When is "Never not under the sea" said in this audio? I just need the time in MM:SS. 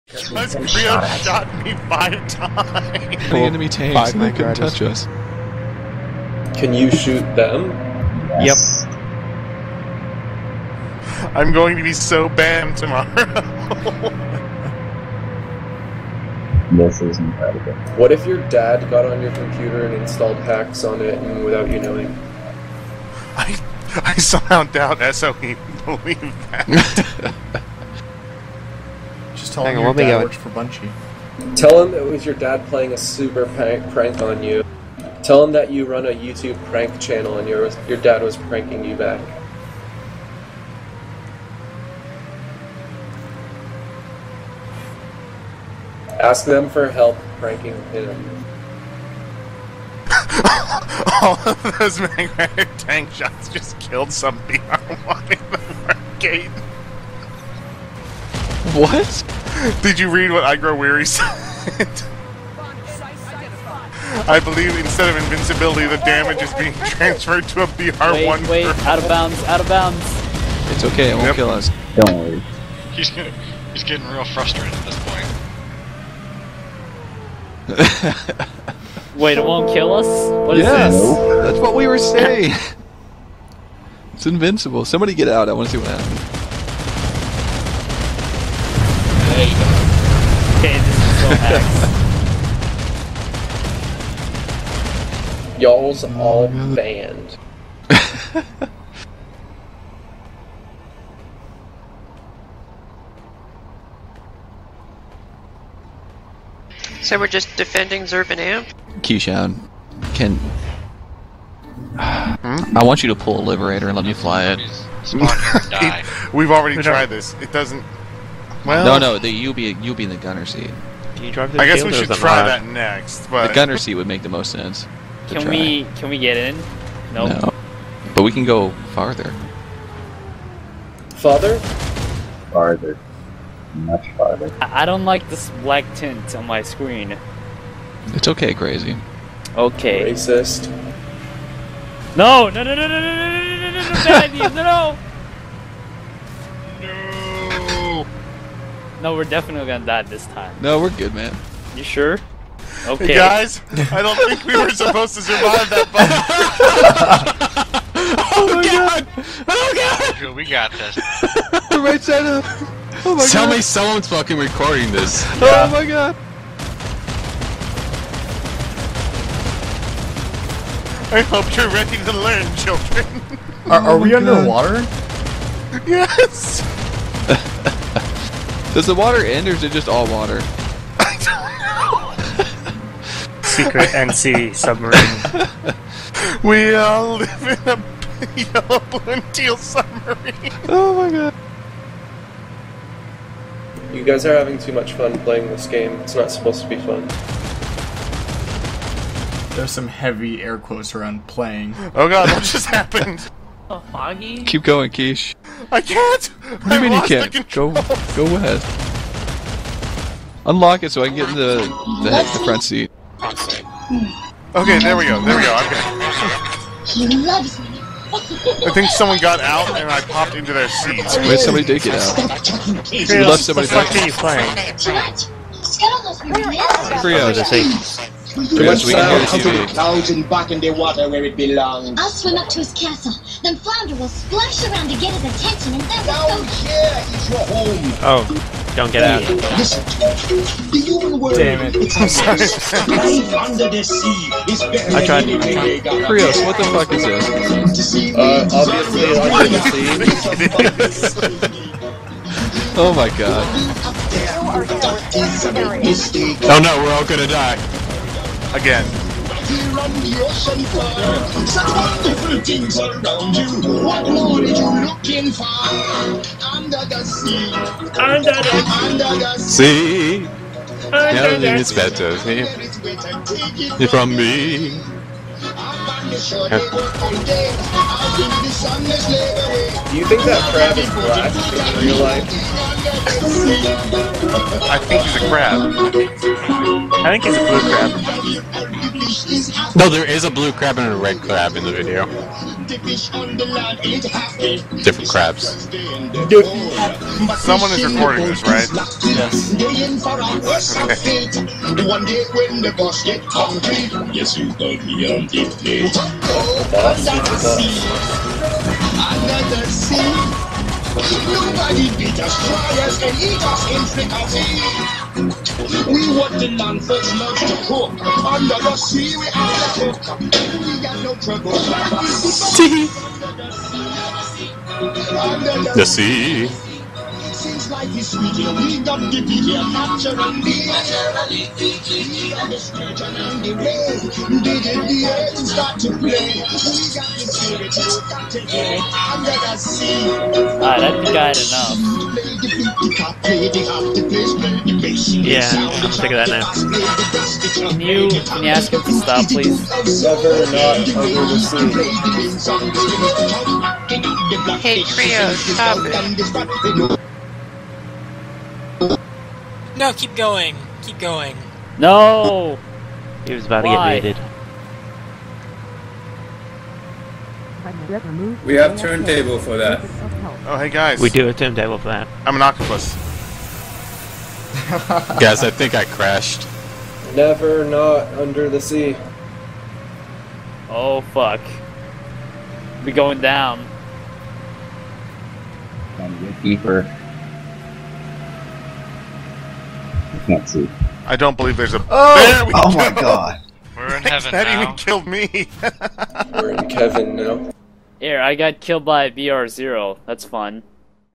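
06:17.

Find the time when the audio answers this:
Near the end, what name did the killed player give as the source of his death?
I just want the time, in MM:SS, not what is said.
06:39.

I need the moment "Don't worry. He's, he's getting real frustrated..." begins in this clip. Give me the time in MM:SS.
01:11.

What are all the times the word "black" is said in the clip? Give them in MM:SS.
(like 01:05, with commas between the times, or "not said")
02:15, 04:40.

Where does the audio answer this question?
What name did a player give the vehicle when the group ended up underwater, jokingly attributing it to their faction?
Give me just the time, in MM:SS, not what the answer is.
03:03.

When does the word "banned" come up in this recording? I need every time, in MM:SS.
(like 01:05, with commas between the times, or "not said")
01:36.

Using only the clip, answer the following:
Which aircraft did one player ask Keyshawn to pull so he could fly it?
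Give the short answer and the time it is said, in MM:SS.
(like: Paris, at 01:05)
Liberator, at 01:53.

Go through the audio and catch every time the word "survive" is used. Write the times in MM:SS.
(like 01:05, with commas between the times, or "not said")
02:35.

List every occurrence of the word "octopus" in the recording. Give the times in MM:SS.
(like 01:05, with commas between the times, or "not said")
06:12.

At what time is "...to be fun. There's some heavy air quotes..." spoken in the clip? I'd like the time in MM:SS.
03:16.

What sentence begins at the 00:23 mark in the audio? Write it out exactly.
I I somehow doubt SOE believe that.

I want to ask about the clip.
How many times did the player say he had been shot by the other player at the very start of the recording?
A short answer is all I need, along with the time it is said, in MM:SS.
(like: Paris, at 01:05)
5, at 00:01.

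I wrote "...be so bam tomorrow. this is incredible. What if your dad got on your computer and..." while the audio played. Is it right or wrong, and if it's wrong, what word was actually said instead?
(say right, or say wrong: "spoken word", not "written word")
right.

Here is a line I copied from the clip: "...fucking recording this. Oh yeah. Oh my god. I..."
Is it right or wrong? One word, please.
right.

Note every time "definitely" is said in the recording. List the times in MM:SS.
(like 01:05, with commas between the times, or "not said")
02:29.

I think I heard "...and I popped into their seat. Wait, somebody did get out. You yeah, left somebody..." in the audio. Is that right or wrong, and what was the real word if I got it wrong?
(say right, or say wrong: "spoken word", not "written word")
right.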